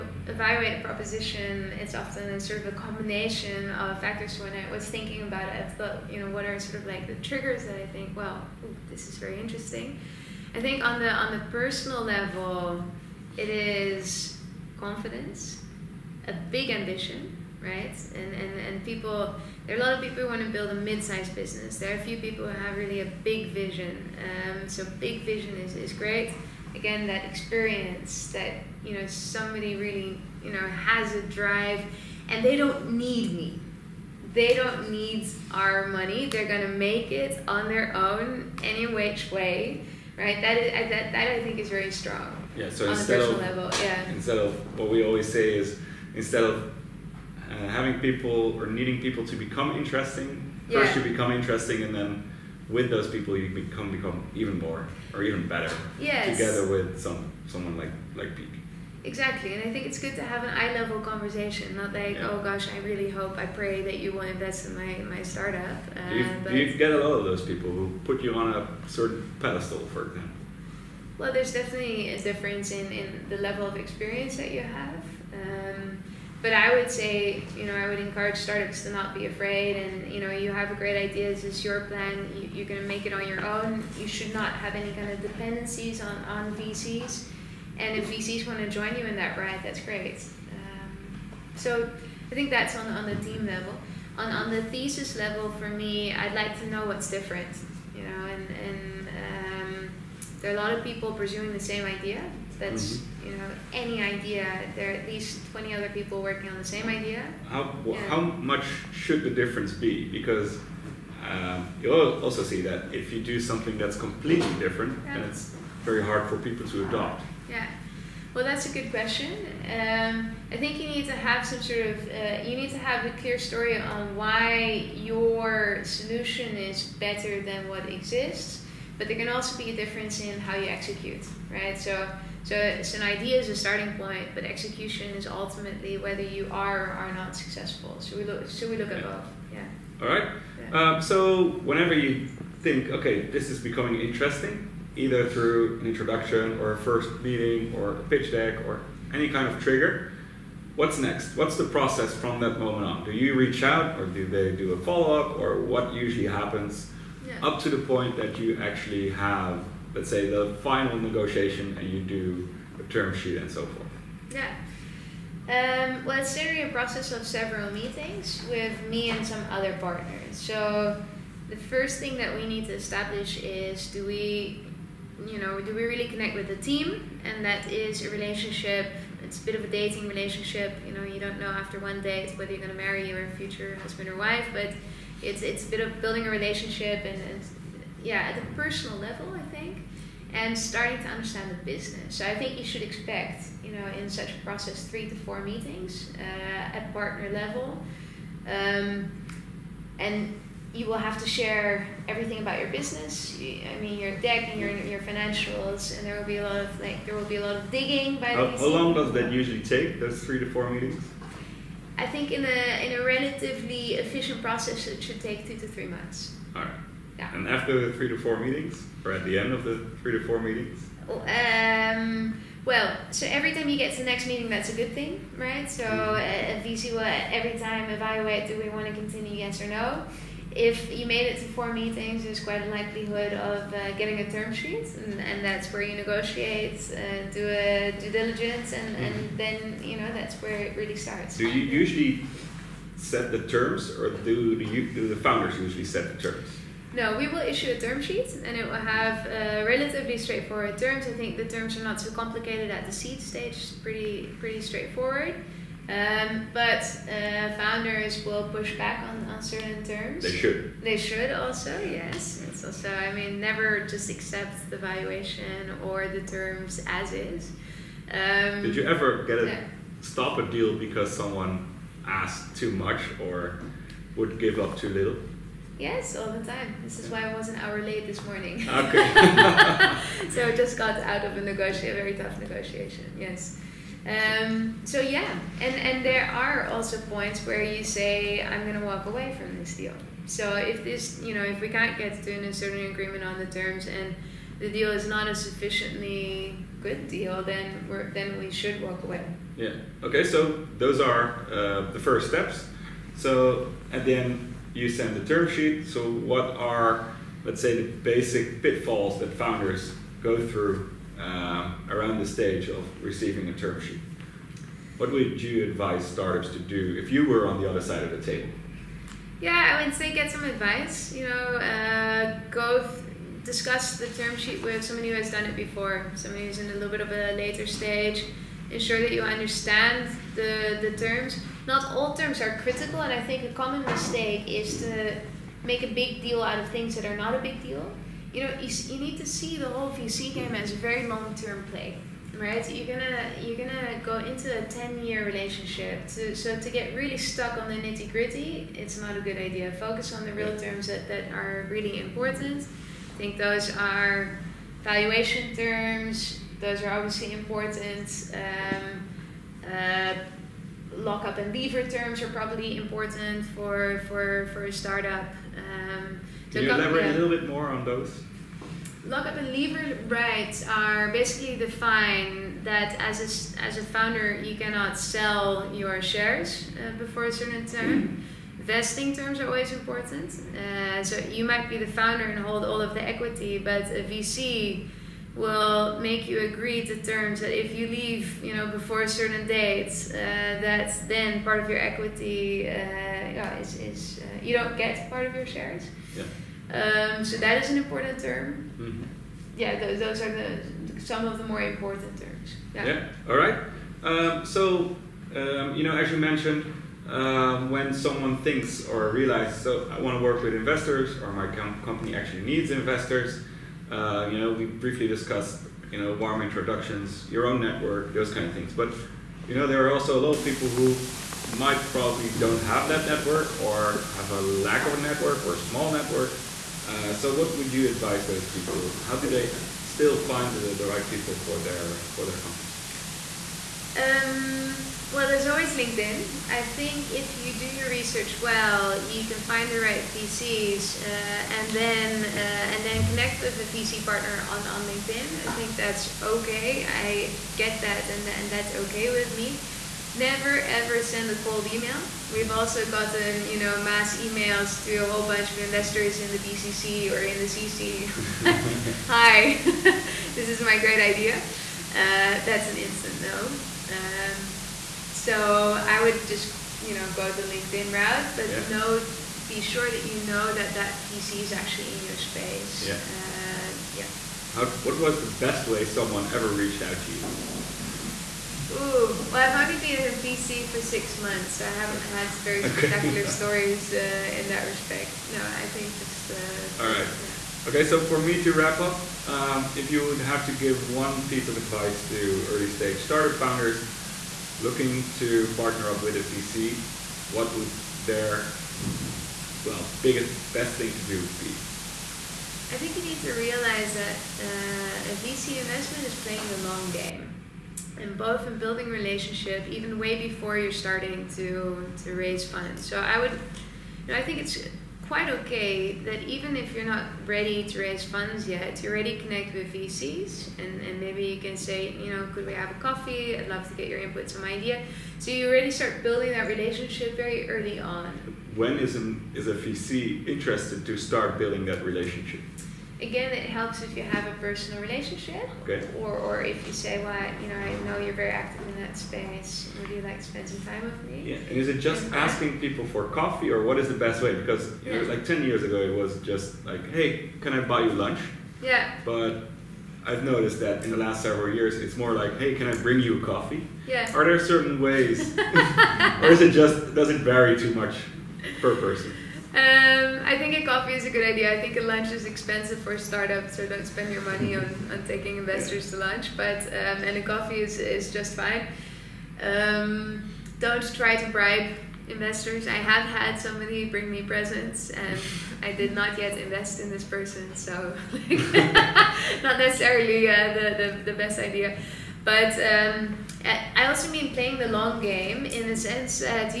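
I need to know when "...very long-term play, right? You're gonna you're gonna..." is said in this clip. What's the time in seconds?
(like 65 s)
340 s.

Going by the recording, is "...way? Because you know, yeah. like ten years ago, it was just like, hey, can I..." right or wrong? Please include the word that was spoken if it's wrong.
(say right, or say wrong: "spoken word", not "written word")
right.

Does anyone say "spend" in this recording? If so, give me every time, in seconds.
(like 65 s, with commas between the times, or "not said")
540 s, 563 s.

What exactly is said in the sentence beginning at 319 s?
Yeah, I would say get some advice.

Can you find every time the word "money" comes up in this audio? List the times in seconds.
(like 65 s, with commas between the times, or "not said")
35 s, 564 s.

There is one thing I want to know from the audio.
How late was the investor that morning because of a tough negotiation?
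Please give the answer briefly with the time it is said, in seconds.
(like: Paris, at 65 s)
an hour, at 277 s.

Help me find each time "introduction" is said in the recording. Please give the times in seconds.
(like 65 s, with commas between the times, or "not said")
145 s, 416 s.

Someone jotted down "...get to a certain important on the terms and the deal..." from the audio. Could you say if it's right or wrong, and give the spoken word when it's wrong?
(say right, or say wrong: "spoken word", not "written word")
wrong: "agreement", not "important".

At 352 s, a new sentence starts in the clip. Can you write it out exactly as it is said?
I think those are valuation terms.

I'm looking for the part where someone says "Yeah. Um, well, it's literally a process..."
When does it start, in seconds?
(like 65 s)
164 s.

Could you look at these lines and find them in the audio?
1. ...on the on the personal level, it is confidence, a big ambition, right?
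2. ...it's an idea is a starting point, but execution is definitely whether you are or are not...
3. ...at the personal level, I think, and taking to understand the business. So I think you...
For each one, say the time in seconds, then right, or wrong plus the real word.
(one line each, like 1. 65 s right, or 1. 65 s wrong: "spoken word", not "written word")
1. 10 s right
2. 132 s wrong: "ultimately", not "definitely"
3. 188 s wrong: "starting", not "taking".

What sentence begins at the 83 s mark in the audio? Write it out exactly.
You should not have any kind of dependencies on on VCs.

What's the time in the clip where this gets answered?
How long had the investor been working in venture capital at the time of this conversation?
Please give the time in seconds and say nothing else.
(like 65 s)
480 s.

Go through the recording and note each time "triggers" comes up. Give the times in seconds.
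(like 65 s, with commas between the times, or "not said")
7 s, 149 s.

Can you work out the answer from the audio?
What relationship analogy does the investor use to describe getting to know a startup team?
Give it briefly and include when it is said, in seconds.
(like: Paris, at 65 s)
dating relationship, at 179 s.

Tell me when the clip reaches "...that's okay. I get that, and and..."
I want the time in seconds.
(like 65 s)
445 s.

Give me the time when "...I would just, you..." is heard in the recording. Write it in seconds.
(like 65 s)
465 s.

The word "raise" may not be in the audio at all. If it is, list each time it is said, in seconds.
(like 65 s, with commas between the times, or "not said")
512 s, 517 s.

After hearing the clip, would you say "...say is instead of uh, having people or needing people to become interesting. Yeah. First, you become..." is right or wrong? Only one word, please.
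right.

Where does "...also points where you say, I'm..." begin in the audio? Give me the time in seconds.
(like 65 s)
286 s.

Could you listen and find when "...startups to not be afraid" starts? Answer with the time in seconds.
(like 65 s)
78 s.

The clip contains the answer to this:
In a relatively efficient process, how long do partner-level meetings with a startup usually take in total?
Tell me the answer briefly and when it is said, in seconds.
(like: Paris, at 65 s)
2 to 3 months, at 215 s.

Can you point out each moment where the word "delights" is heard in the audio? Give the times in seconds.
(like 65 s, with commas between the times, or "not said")
not said.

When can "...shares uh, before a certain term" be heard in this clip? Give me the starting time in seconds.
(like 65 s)
376 s.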